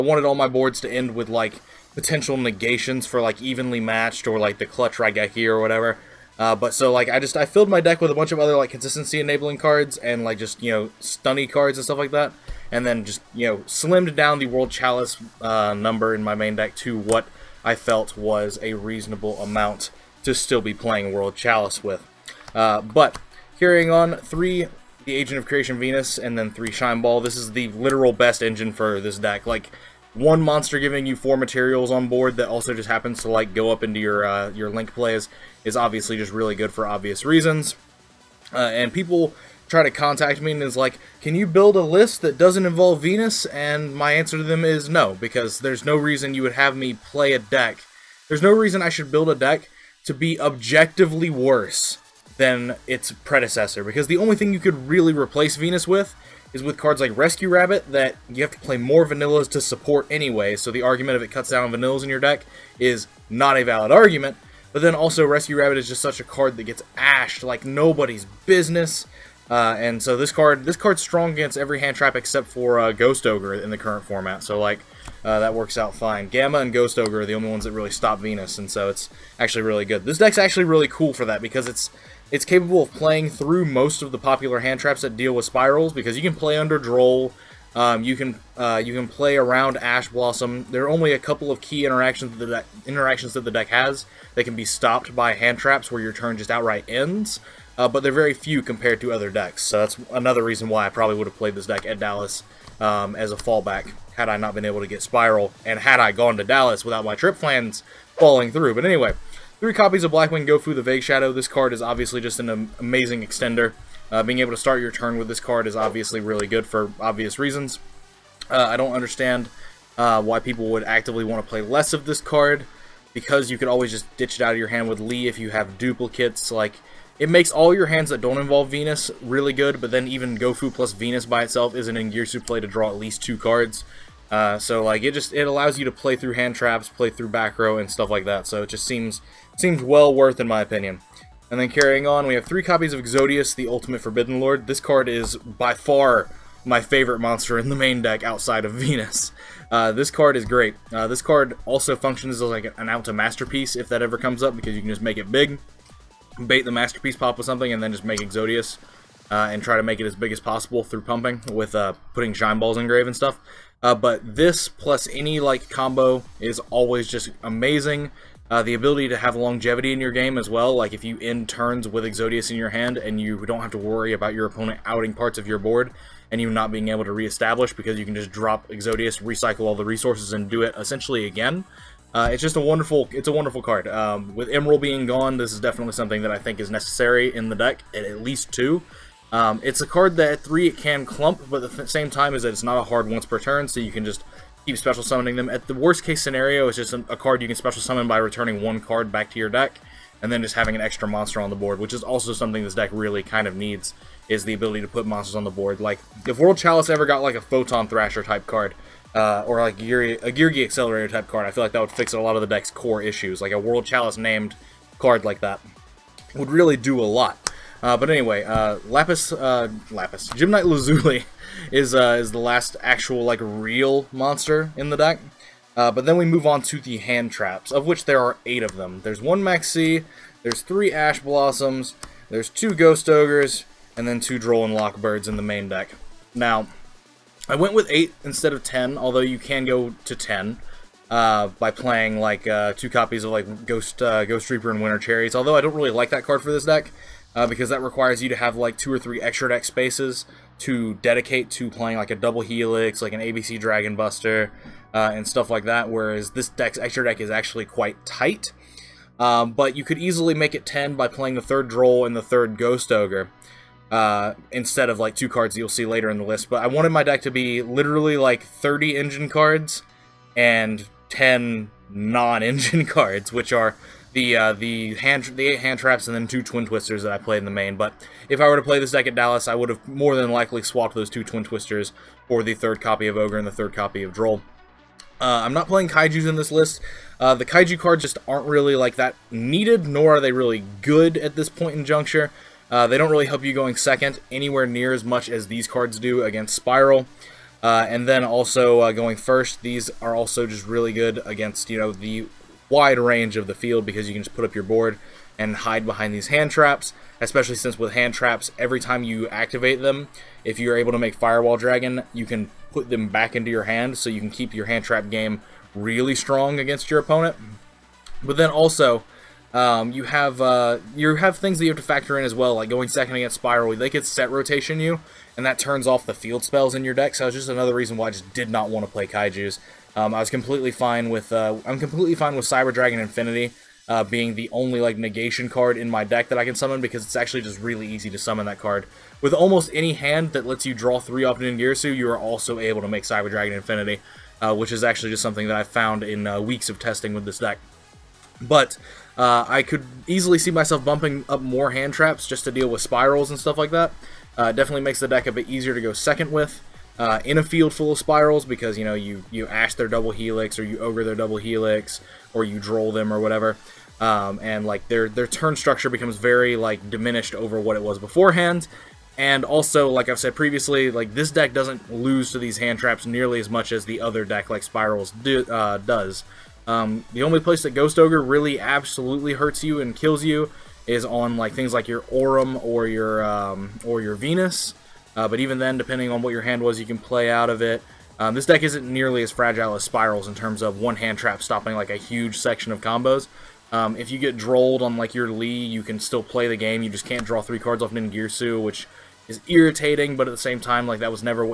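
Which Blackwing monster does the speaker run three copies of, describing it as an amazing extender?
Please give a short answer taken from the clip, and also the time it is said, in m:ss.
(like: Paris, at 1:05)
Blackwing Gofu the Vague Shadow, at 1:50.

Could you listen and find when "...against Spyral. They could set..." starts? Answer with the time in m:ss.
5:23.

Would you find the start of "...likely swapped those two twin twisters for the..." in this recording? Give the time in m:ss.
4:40.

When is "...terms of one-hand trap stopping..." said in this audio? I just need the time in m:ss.
6:30.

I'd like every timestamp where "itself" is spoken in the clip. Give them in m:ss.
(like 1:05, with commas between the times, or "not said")
2:11.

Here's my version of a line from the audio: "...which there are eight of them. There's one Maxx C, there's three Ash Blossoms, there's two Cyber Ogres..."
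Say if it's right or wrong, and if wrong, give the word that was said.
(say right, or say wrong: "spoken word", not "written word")
wrong: "Ghost", not "Cyber".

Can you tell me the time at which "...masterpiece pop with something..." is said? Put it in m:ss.
2:36.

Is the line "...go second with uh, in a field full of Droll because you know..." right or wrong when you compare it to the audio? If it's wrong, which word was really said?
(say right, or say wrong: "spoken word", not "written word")
wrong: "Spyrals", not "Droll".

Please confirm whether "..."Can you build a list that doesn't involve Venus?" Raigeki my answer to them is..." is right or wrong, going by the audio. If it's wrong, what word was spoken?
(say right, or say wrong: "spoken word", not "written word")
wrong: "And", not "Raigeki".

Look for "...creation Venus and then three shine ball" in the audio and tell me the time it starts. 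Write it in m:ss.
0:25.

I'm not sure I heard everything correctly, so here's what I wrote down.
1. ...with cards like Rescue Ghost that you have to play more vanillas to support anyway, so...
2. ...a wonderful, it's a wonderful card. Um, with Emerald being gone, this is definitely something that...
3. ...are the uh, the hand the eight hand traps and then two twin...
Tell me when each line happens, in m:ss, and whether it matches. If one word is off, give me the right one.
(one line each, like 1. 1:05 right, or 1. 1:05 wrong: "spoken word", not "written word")
1. 0:56 wrong: "Rabbit", not "Ghost"
2. 3:02 right
3. 4:33 right.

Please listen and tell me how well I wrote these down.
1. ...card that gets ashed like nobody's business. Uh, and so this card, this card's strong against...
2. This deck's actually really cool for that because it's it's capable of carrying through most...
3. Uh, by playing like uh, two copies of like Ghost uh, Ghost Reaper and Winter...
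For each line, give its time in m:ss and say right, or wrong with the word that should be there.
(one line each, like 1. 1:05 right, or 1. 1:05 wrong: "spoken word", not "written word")
1. 1:06 right
2. 1:20 wrong: "playing", not "carrying"
3. 4:01 right.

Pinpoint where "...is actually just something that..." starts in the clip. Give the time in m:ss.
5:44.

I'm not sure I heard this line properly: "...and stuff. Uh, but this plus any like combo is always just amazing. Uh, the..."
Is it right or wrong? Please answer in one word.
right.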